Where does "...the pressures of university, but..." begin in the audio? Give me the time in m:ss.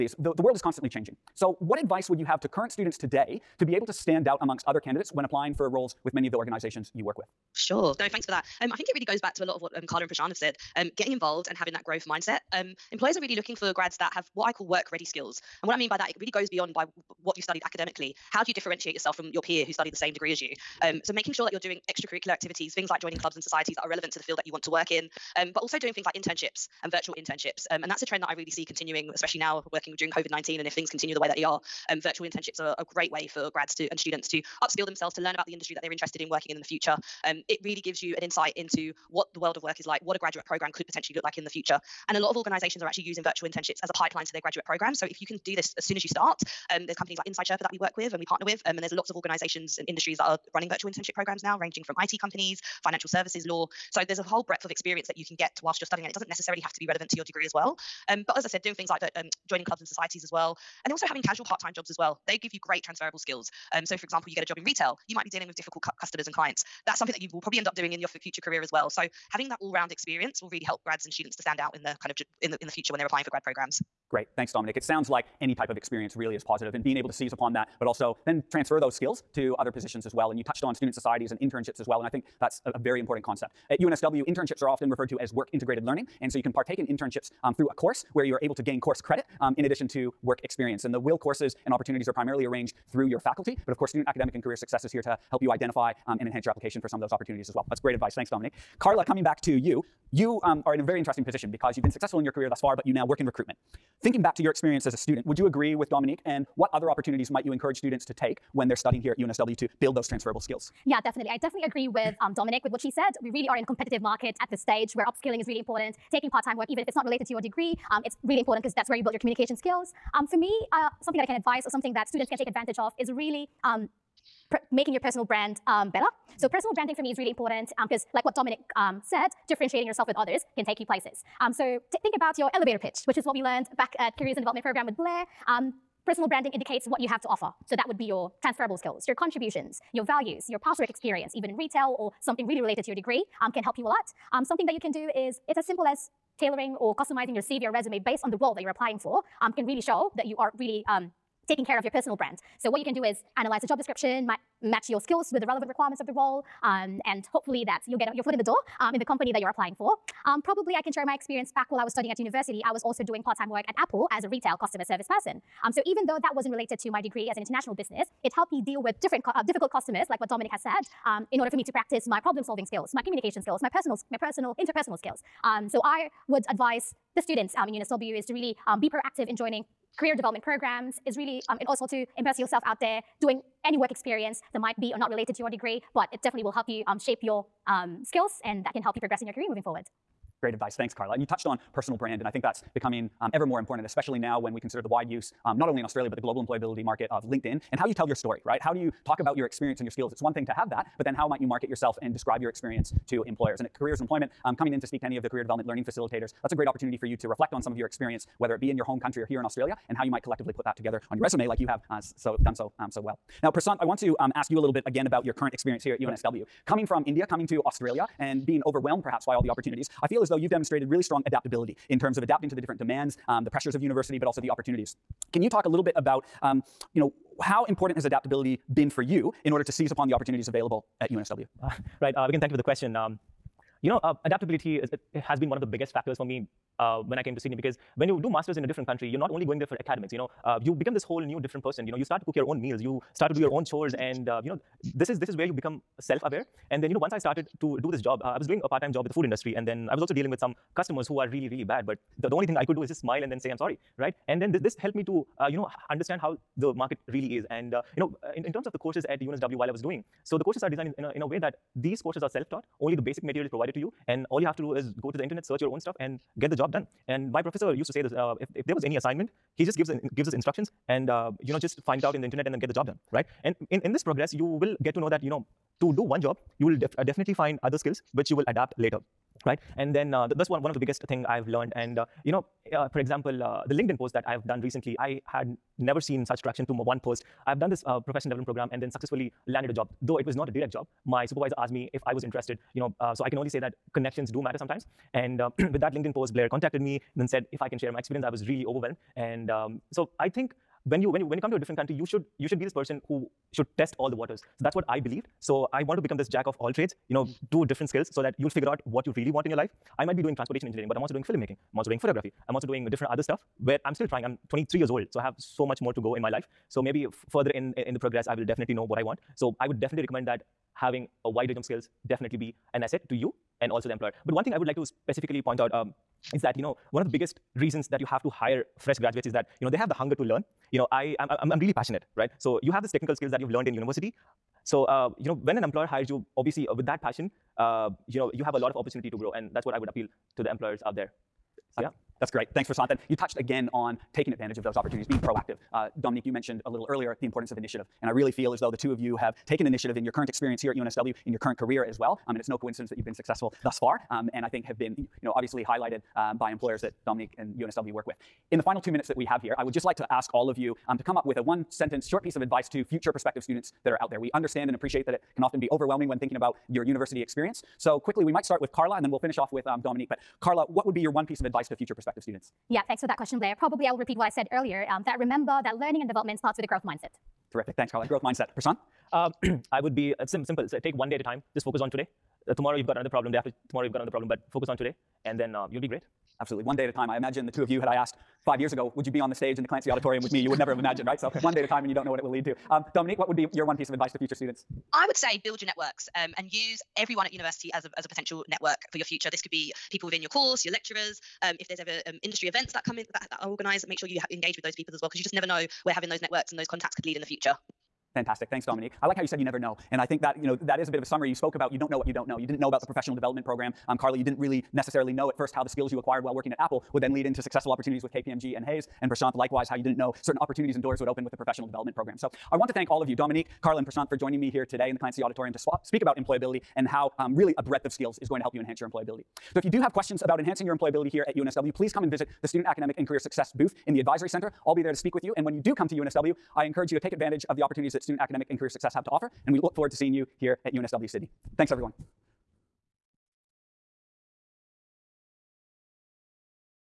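3:43.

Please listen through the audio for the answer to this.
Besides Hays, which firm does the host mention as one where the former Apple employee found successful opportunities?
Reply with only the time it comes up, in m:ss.
6:58.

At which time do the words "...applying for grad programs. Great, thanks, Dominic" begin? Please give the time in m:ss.
1:13.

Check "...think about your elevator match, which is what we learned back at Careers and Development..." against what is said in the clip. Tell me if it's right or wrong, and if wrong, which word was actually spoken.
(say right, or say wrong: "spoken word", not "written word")
wrong: "pitch", not "match".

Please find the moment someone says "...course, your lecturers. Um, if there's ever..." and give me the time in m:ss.
6:40.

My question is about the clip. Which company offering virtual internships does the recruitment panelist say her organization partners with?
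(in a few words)
Inside Sherpa.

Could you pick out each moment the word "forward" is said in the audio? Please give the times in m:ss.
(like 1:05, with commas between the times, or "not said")
3:09, 7:19.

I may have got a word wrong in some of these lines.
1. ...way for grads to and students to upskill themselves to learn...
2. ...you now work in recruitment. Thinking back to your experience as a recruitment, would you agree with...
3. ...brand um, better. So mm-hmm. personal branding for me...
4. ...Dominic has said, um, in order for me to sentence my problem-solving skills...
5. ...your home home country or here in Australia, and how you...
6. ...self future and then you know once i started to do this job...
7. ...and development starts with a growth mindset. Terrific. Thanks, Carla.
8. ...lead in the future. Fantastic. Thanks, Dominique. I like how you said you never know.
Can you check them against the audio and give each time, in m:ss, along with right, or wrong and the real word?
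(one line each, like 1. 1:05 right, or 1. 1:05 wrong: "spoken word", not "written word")
1. 0:33 right
2. 1:42 wrong: "student", not "recruitment"
3. 2:05 right
4. 2:50 wrong: "practice", not "sentence"
5. 3:28 right
6. 4:05 wrong: "aware", not "future"
7. 6:16 right
8. 6:47 right.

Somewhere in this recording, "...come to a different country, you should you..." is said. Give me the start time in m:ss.
5:01.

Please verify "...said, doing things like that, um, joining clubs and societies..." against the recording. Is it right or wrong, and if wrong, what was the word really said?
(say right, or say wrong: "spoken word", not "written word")
right.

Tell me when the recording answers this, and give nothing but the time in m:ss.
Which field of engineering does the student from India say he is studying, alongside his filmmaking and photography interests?
5:10.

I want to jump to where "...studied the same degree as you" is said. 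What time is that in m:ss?
0:19.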